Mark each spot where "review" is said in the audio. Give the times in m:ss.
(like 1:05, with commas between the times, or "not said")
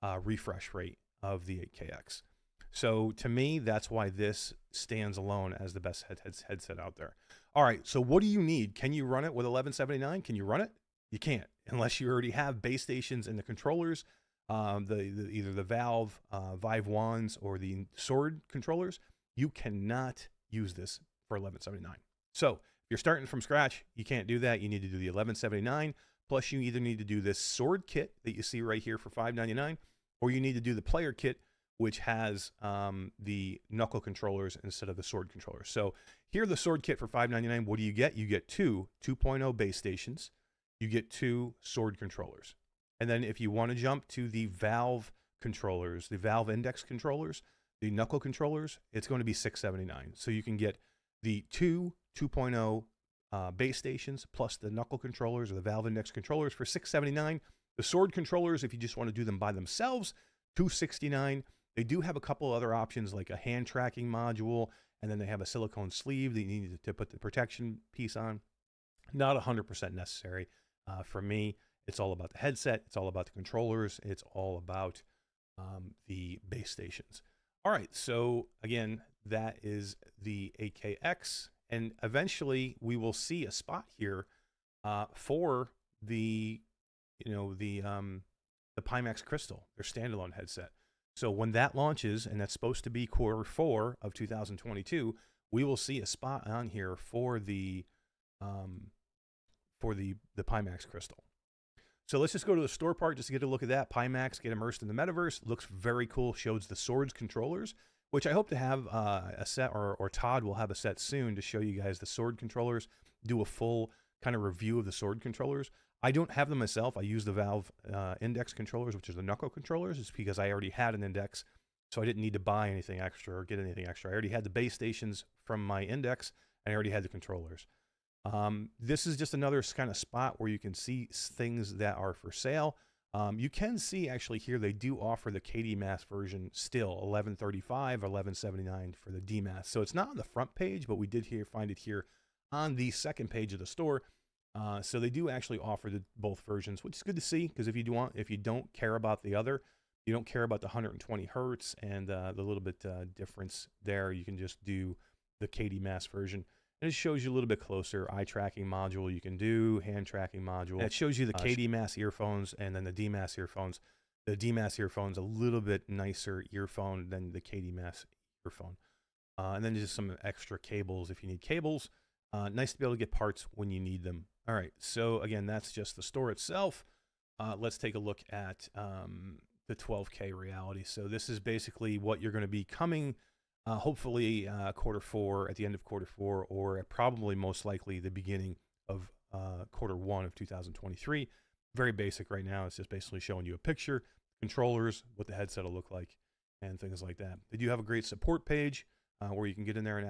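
1:54.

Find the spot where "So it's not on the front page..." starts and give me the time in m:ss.
2:19.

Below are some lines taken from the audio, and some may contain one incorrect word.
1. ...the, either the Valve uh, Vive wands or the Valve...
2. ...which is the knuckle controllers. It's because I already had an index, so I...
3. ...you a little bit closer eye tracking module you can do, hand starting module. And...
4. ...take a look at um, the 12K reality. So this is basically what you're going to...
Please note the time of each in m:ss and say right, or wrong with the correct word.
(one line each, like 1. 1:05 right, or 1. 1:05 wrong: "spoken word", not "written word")
1. 0:15 wrong: "Sword", not "Valve"
2. 1:58 right
3. 2:37 wrong: "tracking", not "starting"
4. 2:57 right.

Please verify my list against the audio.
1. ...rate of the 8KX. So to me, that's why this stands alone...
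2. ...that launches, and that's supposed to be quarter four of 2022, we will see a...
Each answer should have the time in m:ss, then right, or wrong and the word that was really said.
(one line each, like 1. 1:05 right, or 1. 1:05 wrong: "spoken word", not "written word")
1. 0:00 right
2. 1:31 right.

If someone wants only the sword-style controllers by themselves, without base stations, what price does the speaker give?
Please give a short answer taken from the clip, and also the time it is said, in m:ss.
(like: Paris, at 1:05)
2.69, at 1:00.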